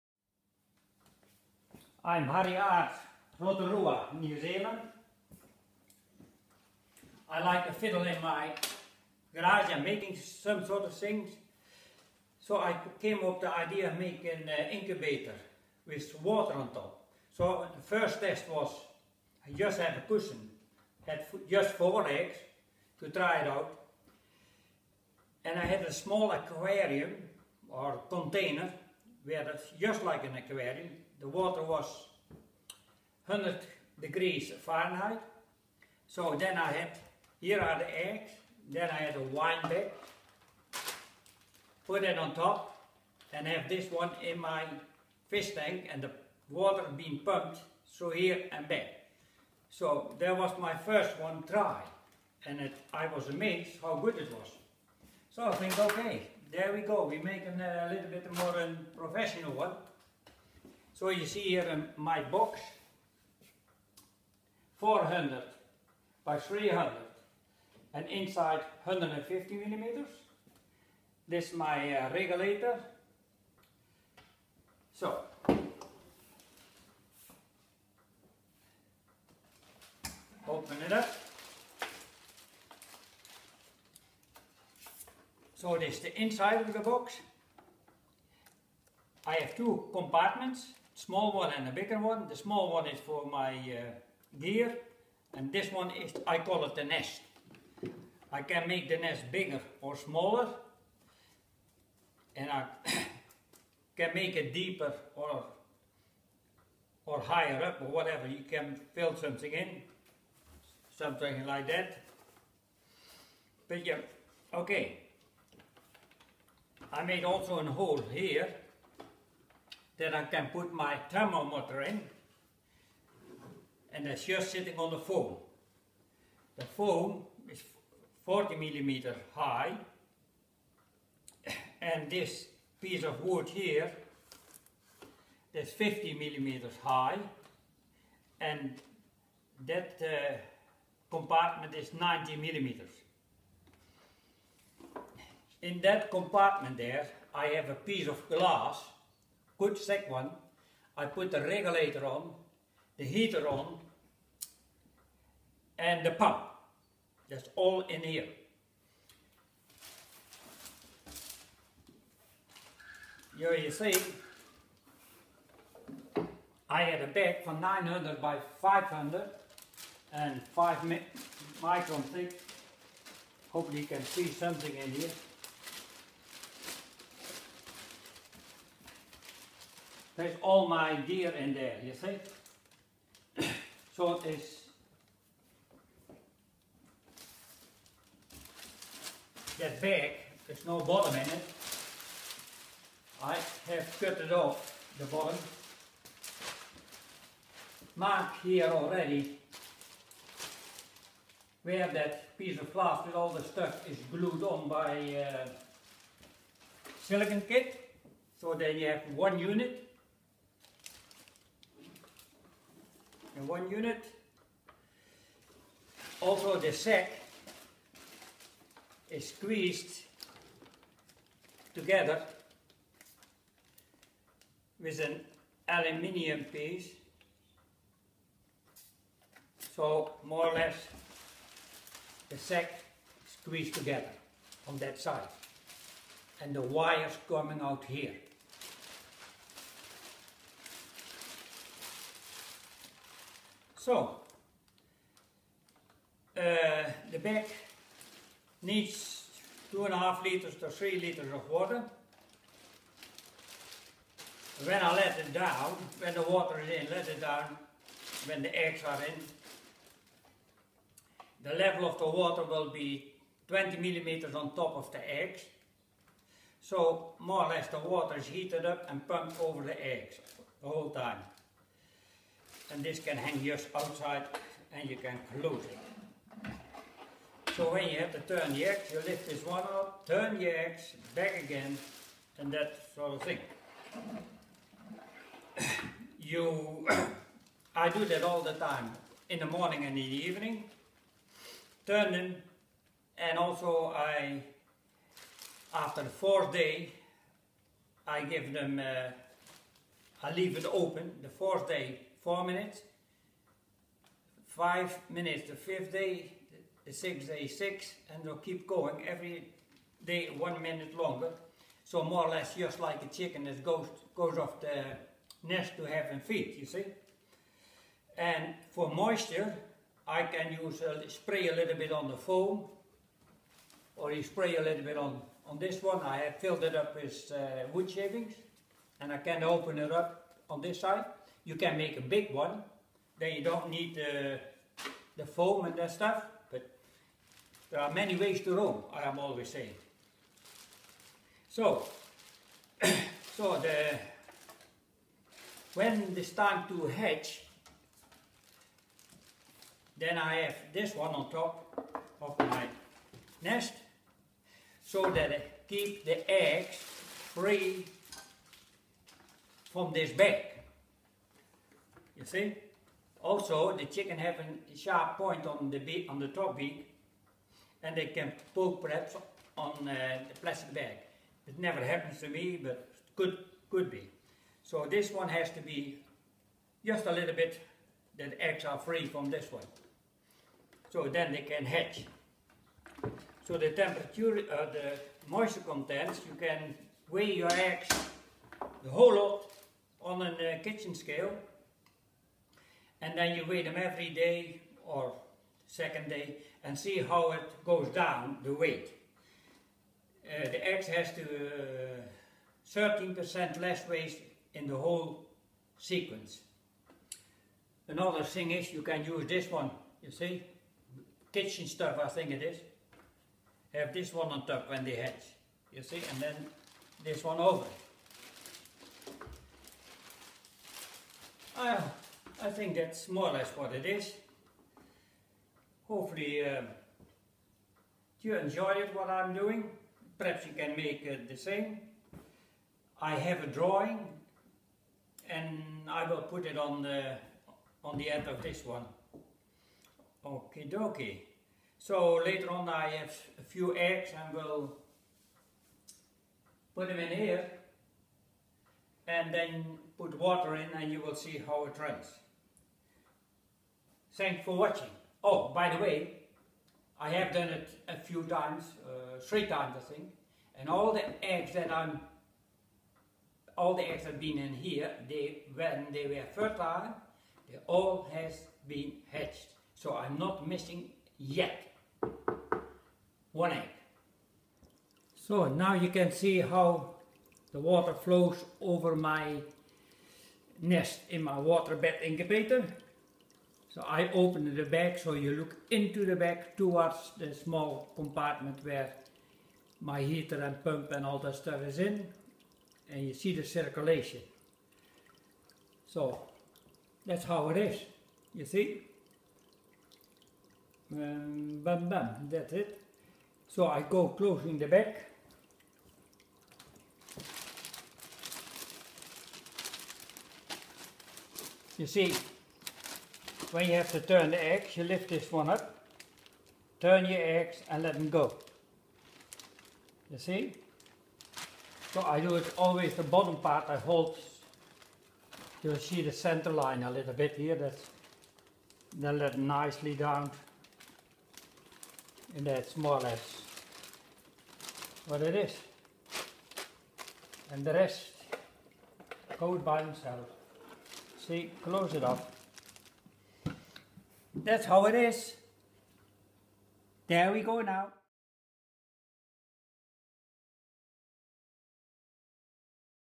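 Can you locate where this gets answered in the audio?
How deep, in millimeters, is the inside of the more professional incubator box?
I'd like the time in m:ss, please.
1:08.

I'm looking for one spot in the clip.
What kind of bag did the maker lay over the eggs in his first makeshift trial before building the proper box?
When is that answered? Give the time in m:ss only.
0:39.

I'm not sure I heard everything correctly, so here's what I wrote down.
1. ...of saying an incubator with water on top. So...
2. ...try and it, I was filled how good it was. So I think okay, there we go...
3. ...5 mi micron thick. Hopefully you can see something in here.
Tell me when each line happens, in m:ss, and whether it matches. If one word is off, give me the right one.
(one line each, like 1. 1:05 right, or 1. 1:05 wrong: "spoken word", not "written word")
1. 0:13 wrong: "making", not "saying"
2. 0:51 wrong: "amazed", not "filled"
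3. 2:50 right.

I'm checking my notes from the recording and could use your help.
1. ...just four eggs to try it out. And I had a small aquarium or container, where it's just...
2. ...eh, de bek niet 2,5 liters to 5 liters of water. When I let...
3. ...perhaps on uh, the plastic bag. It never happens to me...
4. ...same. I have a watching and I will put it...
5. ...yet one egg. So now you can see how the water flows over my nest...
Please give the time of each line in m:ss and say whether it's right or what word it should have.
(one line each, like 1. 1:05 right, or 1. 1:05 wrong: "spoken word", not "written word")
1. 0:21 right
2. 4:06 wrong: "3", not "5"
3. 6:08 right
4. 7:11 wrong: "drawing", not "watching"
5. 7:51 right.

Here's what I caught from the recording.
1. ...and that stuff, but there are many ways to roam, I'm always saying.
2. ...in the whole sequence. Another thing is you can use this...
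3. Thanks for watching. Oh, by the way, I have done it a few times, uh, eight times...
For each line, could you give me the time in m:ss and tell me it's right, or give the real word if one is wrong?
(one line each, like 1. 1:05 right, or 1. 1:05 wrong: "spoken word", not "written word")
1. 5:35 right
2. 6:44 right
3. 7:34 wrong: "three", not "eight".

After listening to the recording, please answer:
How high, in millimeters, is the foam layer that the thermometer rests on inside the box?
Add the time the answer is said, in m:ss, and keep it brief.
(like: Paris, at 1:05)
40 millimeters, at 2:08.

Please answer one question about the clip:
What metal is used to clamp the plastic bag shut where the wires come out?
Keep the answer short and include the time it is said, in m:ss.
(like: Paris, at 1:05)
aluminium, at 3:45.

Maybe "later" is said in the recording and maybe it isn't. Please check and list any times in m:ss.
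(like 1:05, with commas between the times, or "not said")
7:22.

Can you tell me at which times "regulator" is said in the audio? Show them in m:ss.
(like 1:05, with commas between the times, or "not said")
1:12, 2:31.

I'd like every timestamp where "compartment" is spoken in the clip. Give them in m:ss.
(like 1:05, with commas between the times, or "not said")
1:29, 2:21, 2:26, 8:07.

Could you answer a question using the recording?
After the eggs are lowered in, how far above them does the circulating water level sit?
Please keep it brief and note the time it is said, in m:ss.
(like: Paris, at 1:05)
20 millimeters, at 4:23.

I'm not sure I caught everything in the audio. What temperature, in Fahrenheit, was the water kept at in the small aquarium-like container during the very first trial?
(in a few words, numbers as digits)
100 degrees Fahrenheit.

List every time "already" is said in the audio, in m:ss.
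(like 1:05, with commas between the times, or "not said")
3:18.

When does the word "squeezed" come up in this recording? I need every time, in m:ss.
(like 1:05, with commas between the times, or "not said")
3:39, 3:53.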